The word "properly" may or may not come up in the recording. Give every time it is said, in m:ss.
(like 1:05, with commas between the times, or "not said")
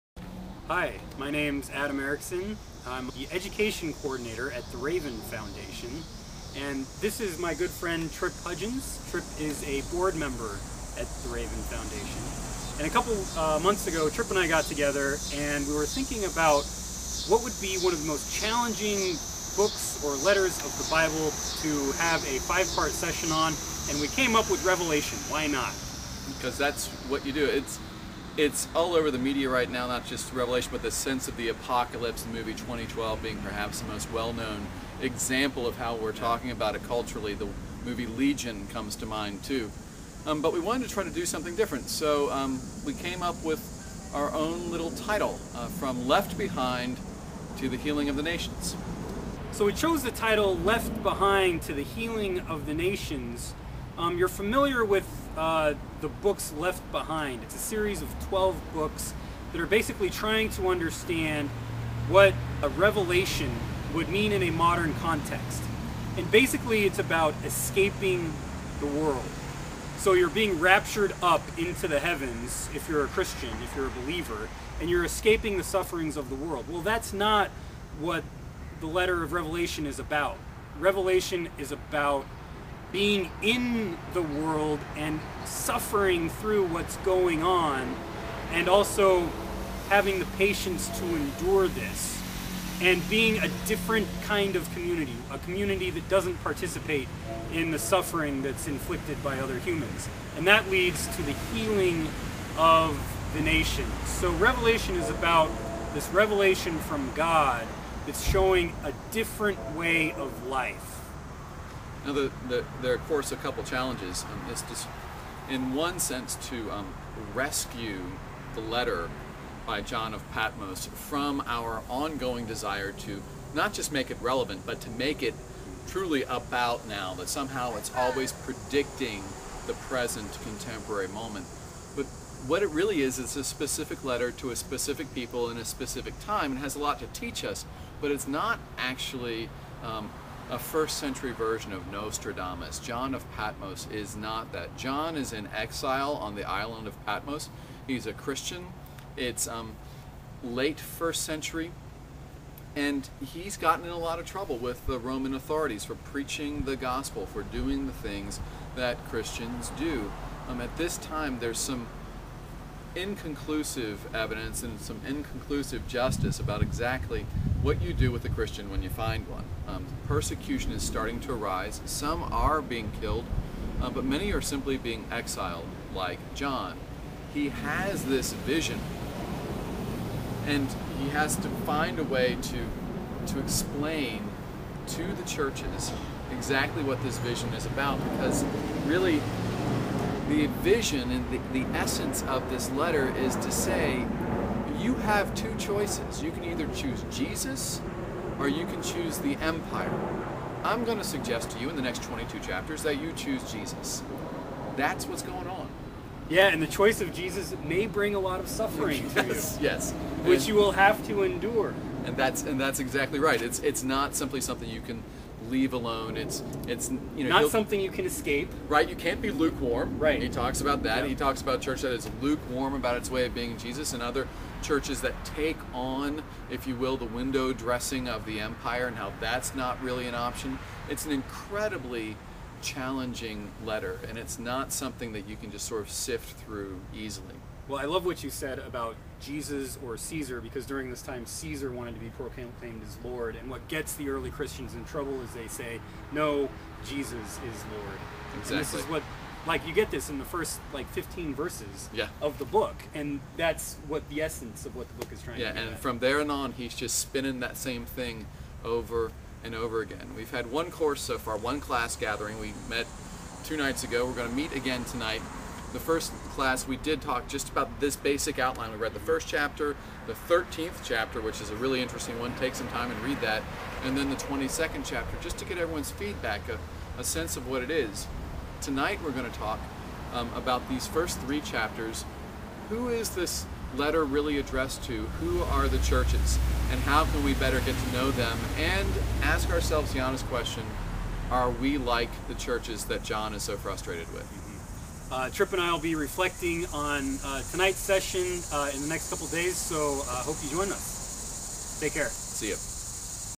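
not said.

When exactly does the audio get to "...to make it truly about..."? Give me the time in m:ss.
2:04.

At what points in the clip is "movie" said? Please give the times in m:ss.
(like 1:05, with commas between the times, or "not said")
0:32, 0:37.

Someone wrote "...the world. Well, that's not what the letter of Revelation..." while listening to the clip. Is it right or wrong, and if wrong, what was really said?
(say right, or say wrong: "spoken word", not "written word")
right.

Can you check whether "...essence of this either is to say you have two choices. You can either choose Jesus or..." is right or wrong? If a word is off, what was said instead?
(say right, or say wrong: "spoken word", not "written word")
wrong: "letter", not "either".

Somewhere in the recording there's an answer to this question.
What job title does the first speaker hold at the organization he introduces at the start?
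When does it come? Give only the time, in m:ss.
0:03.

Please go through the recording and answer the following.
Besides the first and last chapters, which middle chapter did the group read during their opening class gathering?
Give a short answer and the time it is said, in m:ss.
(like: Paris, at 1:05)
13th chapter, at 4:30.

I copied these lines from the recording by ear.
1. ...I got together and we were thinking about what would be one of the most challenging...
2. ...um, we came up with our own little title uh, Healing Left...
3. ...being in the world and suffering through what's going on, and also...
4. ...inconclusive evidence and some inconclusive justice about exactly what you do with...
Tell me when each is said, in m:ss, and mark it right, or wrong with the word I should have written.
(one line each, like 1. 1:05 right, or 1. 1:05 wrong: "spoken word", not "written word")
1. 0:14 right
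2. 0:42 wrong: "From", not "Healing"
3. 1:22 right
4. 2:42 right.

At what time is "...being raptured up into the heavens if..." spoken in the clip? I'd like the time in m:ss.
1:10.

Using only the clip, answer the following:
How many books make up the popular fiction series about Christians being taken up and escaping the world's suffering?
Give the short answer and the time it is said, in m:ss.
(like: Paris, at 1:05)
12, at 0:58.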